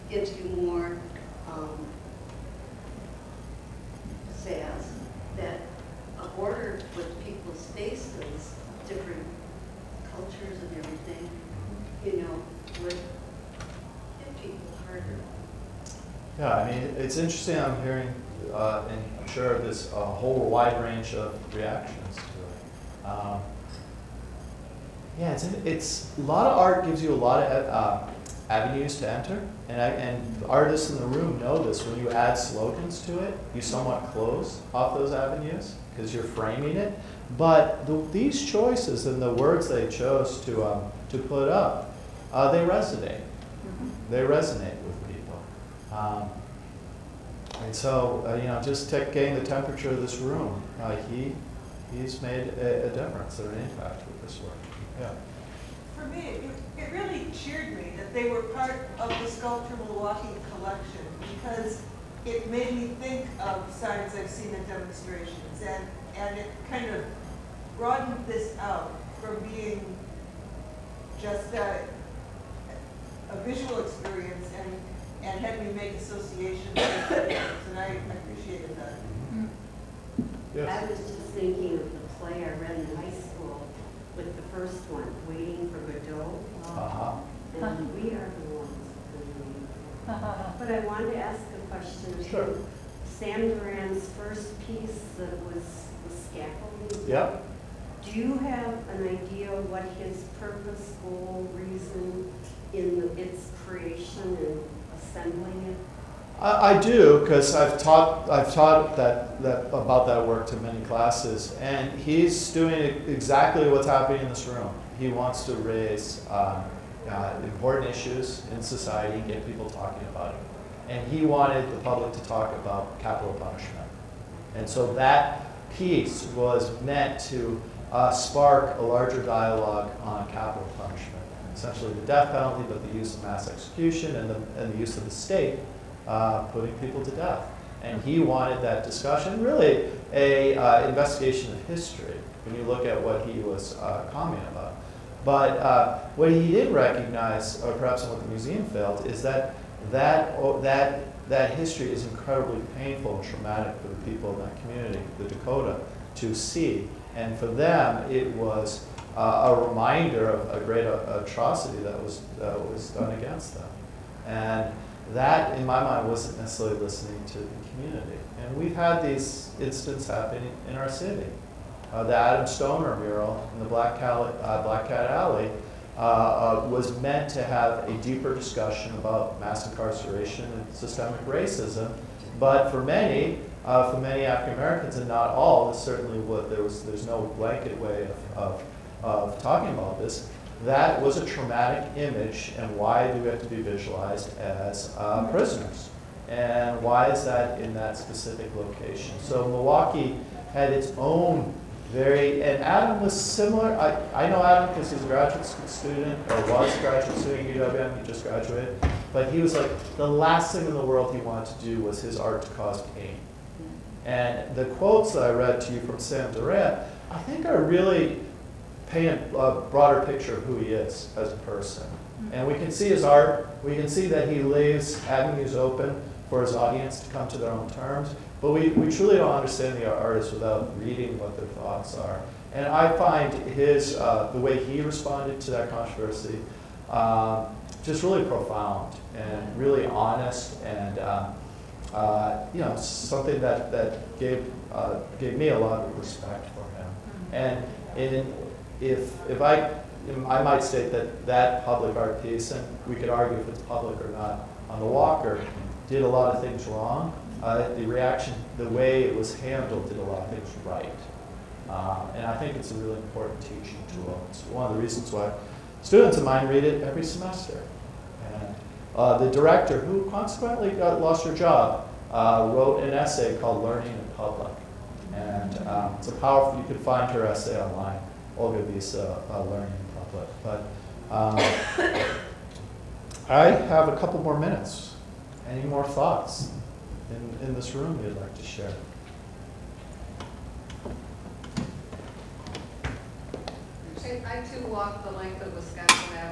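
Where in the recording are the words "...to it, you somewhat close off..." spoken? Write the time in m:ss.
0:33.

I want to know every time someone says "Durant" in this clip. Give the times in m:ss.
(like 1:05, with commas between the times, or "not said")
1:33, 3:36.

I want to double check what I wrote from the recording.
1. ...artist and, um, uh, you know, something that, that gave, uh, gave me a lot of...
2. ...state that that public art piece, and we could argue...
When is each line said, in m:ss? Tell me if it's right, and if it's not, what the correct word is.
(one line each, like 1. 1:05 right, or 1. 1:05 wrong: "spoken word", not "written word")
1. 3:59 wrong: "honest", not "artist"
2. 4:10 right.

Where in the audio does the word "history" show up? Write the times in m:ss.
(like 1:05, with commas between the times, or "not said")
2:21, 2:31.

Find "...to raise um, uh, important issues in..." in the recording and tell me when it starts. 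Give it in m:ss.
1:55.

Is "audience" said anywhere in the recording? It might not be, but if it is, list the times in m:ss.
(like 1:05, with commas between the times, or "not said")
3:46.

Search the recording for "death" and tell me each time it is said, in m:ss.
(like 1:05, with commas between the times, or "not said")
2:12, 2:17.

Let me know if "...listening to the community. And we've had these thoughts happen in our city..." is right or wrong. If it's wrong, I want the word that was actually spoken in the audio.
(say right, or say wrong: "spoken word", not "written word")
wrong: "incidents", not "thoughts".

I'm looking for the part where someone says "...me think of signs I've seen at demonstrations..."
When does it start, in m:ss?
1:02.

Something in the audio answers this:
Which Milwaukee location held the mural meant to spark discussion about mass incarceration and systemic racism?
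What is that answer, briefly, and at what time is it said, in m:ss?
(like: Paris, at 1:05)
Black Cat Alley, at 2:54.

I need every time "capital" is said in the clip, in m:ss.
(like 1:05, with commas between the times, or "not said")
2:02, 2:10.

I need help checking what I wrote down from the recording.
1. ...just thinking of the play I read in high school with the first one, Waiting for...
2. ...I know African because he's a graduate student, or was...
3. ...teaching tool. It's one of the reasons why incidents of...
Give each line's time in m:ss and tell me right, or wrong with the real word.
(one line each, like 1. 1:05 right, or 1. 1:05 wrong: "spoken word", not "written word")
1. 1:20 right
2. 3:24 wrong: "Adam", not "African"
3. 4:23 wrong: "students", not "incidents".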